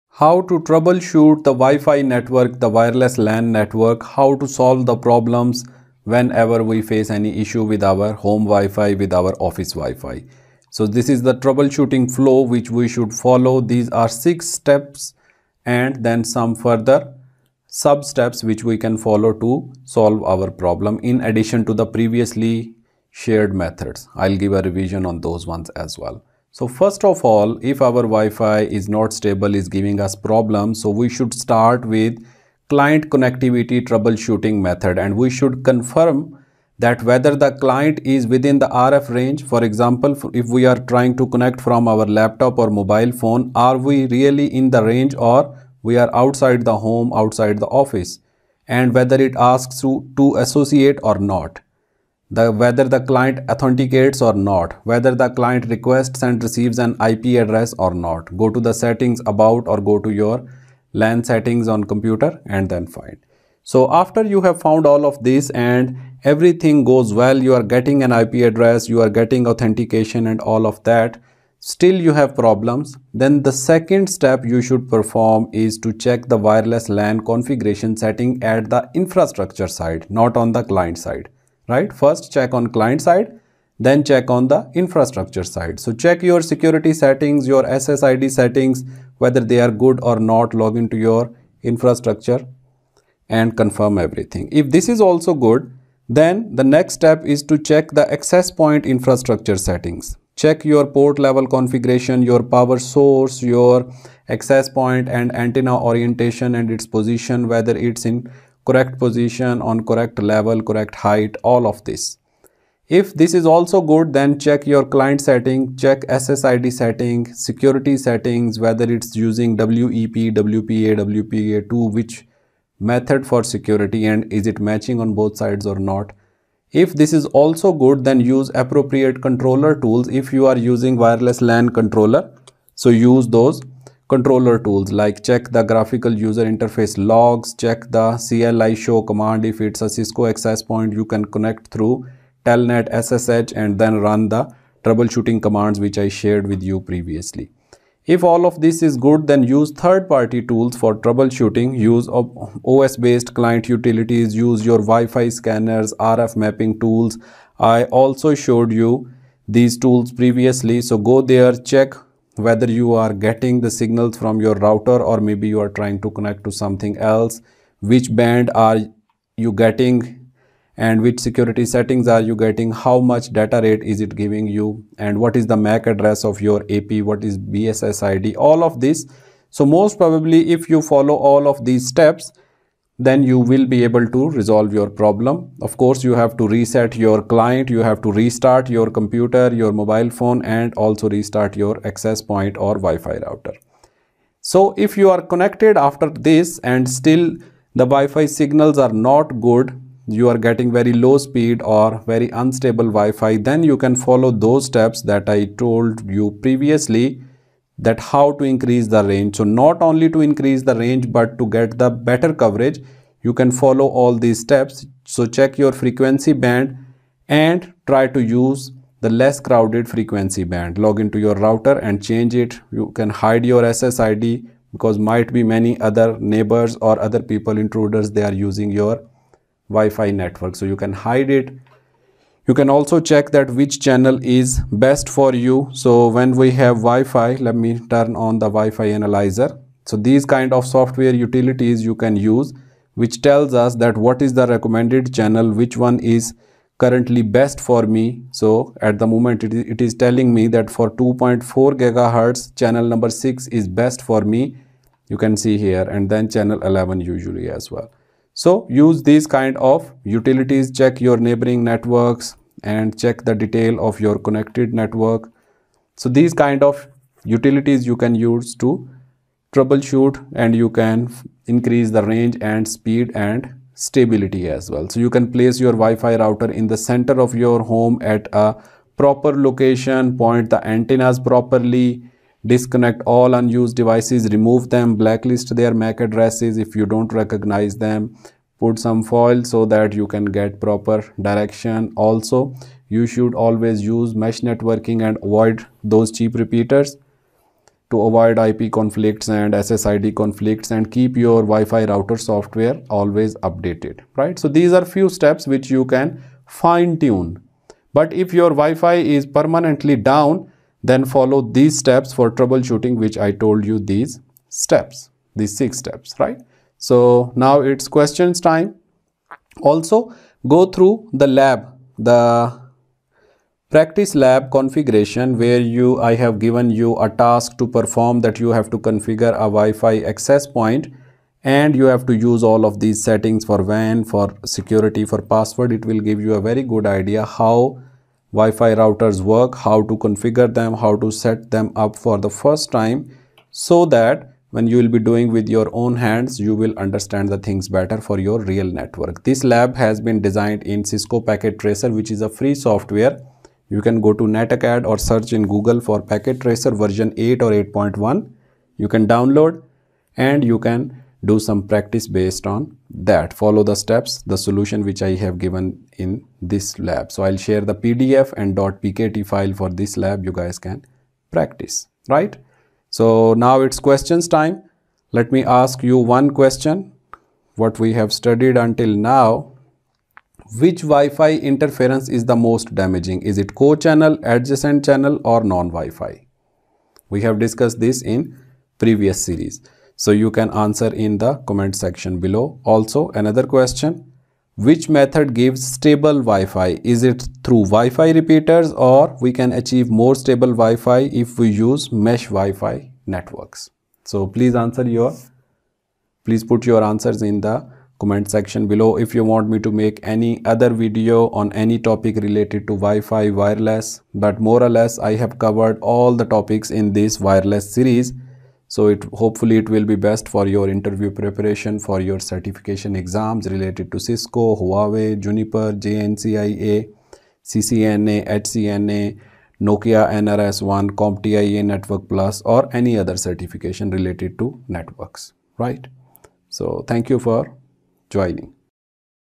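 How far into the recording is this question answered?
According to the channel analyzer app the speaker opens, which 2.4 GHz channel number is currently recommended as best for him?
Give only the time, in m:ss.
4:12.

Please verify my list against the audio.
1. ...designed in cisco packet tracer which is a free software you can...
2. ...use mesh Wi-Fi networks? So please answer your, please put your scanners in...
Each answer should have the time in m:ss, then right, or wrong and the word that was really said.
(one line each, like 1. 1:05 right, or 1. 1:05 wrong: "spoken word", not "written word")
1. 5:50 right
2. 6:41 wrong: "answers", not "scanners".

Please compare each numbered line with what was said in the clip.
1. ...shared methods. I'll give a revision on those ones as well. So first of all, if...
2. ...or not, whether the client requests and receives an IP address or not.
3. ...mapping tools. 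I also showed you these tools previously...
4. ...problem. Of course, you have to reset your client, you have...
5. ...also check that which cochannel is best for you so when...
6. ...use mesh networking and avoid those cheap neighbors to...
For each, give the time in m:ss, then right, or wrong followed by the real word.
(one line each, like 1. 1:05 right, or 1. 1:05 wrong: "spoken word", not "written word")
1. 0:23 right
2. 0:54 right
3. 2:36 right
4. 3:04 right
5. 3:52 wrong: "channel", not "cochannel"
6. 4:53 wrong: "repeaters", not "neighbors".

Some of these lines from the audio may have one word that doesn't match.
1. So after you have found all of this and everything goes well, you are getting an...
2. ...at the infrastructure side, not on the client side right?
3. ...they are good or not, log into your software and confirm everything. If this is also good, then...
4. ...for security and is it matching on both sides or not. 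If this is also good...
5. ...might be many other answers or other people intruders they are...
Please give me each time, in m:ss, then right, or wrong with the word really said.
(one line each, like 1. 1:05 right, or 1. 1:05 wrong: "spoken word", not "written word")
1. 1:03 right
2. 1:18 right
3. 1:29 wrong: "infrastructure", not "software"
4. 2:03 right
5. 3:44 wrong: "neighbors", not "answers".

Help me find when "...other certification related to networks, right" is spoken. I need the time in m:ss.
7:12.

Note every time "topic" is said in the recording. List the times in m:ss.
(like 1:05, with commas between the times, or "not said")
6:51, 6:56.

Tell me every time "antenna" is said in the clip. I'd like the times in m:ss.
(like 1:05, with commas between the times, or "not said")
1:45, 4:40.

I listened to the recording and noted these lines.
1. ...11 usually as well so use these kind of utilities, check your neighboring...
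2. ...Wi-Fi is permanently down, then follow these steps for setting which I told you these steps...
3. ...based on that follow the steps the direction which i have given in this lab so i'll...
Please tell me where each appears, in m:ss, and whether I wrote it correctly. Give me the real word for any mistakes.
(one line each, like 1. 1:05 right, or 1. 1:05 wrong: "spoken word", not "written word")
1. 4:16 right
2. 5:08 wrong: "troubleshooting", not "setting"
3. 6:02 wrong: "solution", not "direction".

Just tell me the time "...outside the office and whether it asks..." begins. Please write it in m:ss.
0:47.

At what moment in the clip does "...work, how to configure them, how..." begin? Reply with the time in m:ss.
5:39.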